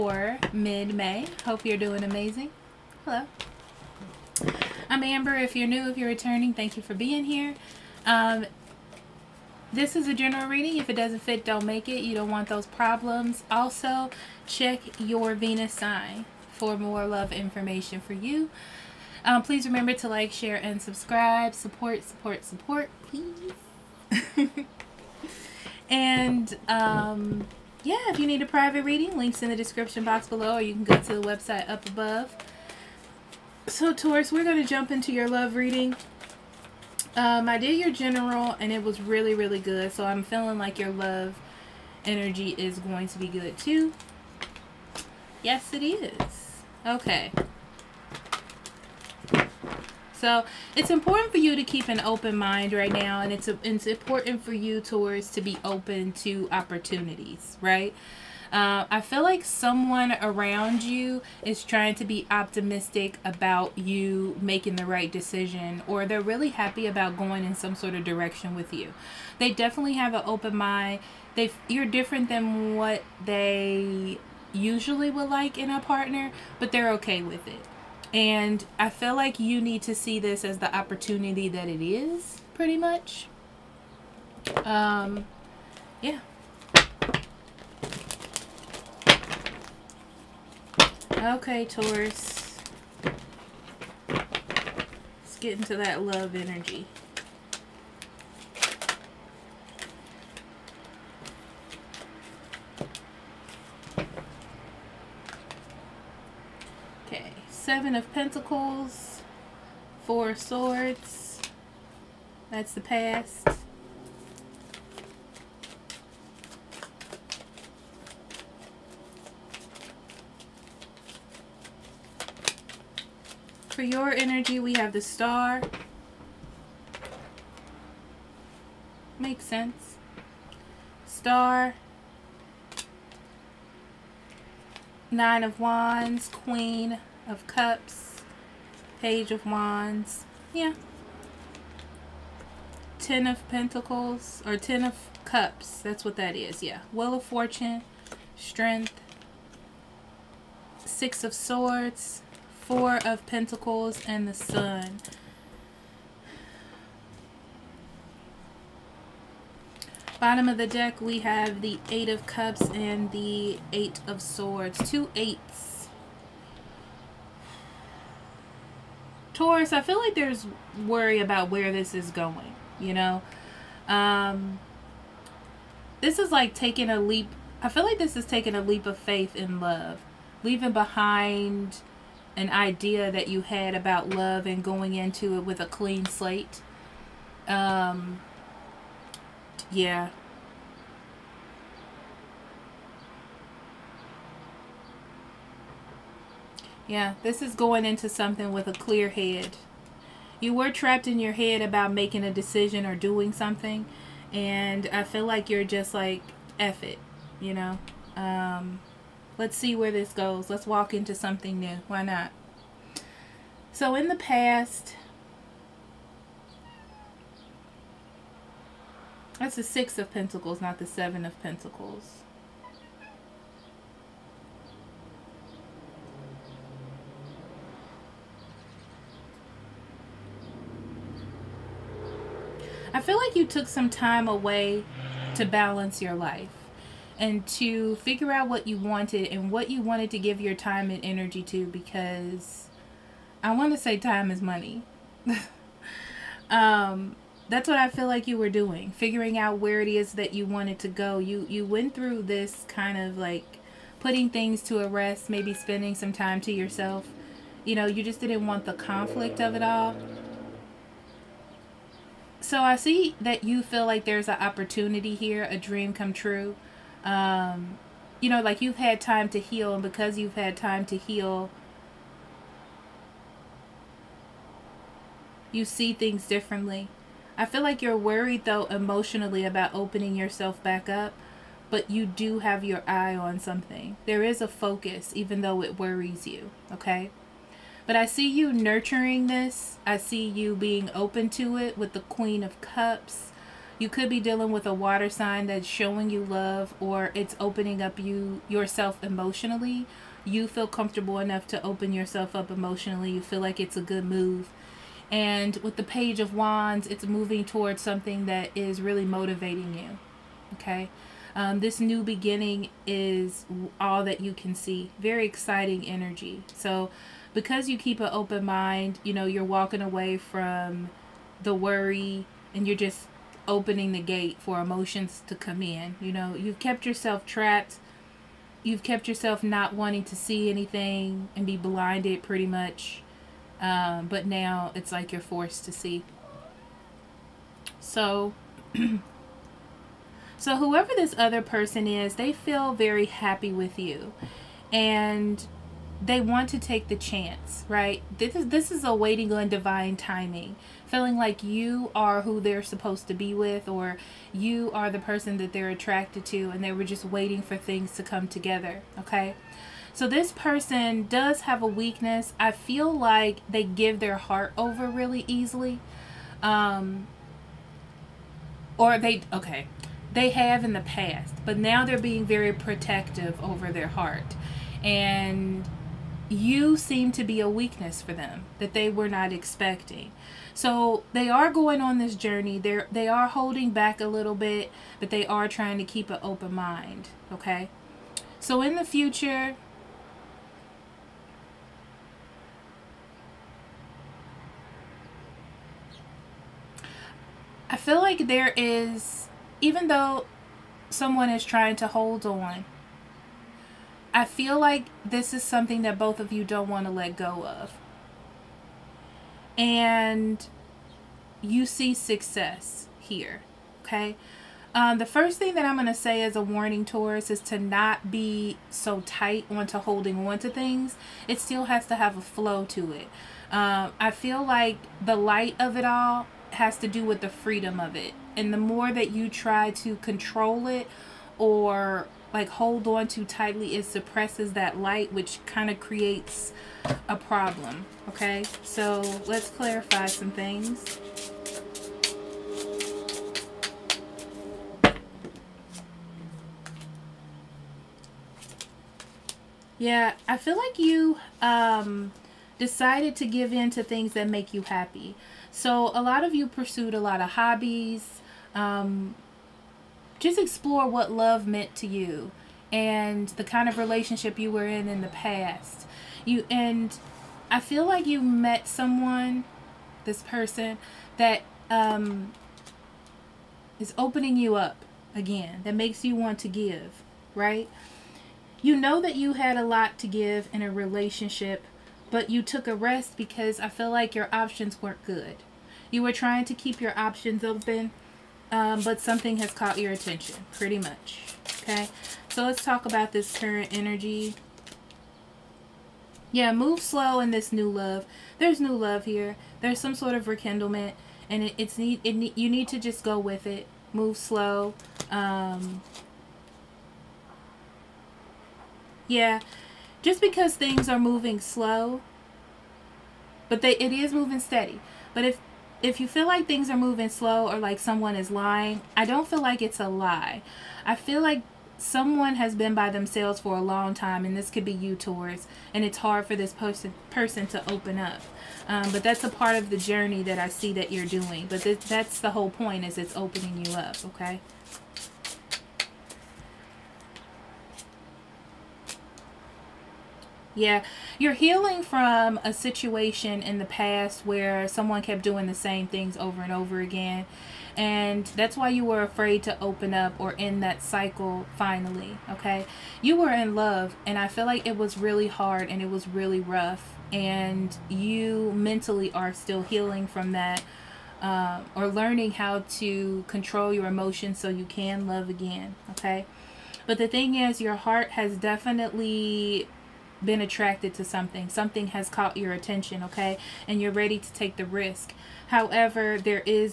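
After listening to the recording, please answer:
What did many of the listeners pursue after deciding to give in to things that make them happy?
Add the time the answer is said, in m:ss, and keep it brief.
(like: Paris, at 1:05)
Hobbies, at 7:37.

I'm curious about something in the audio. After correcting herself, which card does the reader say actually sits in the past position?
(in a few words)
Six of Pentacles.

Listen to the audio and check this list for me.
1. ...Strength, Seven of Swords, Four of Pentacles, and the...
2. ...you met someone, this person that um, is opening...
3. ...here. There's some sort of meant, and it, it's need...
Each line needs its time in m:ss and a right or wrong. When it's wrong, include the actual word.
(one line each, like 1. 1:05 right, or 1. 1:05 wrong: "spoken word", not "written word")
1. 2:28 wrong: "Six", not "Seven"
2. 7:48 right
3. 8:19 wrong: "rekindlement", not "meant".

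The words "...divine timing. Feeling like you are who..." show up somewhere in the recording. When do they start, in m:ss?
5:49.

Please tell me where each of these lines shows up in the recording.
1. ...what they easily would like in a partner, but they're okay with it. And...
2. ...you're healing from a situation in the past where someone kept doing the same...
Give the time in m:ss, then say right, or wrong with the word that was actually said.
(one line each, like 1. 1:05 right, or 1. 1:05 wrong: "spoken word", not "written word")
1. 1:12 wrong: "usually", not "easily"
2. 9:01 right.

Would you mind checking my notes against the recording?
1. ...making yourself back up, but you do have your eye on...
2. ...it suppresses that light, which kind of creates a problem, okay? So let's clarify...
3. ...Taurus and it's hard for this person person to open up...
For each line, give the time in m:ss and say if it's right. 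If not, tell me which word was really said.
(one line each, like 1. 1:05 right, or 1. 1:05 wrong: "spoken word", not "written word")
1. 4:39 wrong: "opening", not "making"
2. 7:13 right
3. 8:44 right.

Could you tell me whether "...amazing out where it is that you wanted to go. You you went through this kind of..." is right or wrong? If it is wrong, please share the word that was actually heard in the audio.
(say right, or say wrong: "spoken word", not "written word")
wrong: "figuring", not "amazing".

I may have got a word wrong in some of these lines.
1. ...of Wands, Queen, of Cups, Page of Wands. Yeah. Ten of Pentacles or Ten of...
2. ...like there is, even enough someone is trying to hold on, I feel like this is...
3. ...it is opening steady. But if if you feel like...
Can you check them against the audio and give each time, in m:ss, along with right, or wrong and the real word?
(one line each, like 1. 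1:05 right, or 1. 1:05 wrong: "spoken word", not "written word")
1. 2:15 right
2. 6:37 wrong: "though", not "enough"
3. 8:33 wrong: "moving", not "opening".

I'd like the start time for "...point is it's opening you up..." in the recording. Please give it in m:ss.
8:52.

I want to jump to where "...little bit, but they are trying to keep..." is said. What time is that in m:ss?
6:24.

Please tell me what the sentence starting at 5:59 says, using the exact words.
So this person does have a weakness.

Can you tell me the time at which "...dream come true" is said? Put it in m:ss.
4:25.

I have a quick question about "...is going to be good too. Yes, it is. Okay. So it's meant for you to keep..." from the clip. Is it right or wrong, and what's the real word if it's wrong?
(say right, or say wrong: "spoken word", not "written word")
wrong: "important", not "meant".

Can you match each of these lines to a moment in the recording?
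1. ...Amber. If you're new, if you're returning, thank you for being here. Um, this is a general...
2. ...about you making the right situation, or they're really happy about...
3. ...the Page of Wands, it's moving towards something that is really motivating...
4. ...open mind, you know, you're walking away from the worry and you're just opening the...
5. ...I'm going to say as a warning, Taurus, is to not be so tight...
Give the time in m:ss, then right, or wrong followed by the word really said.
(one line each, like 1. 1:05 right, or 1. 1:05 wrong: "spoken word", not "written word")
1. 0:05 right
2. 1:03 wrong: "decision", not "situation"
3. 5:05 right
4. 5:18 right
5. 6:55 right.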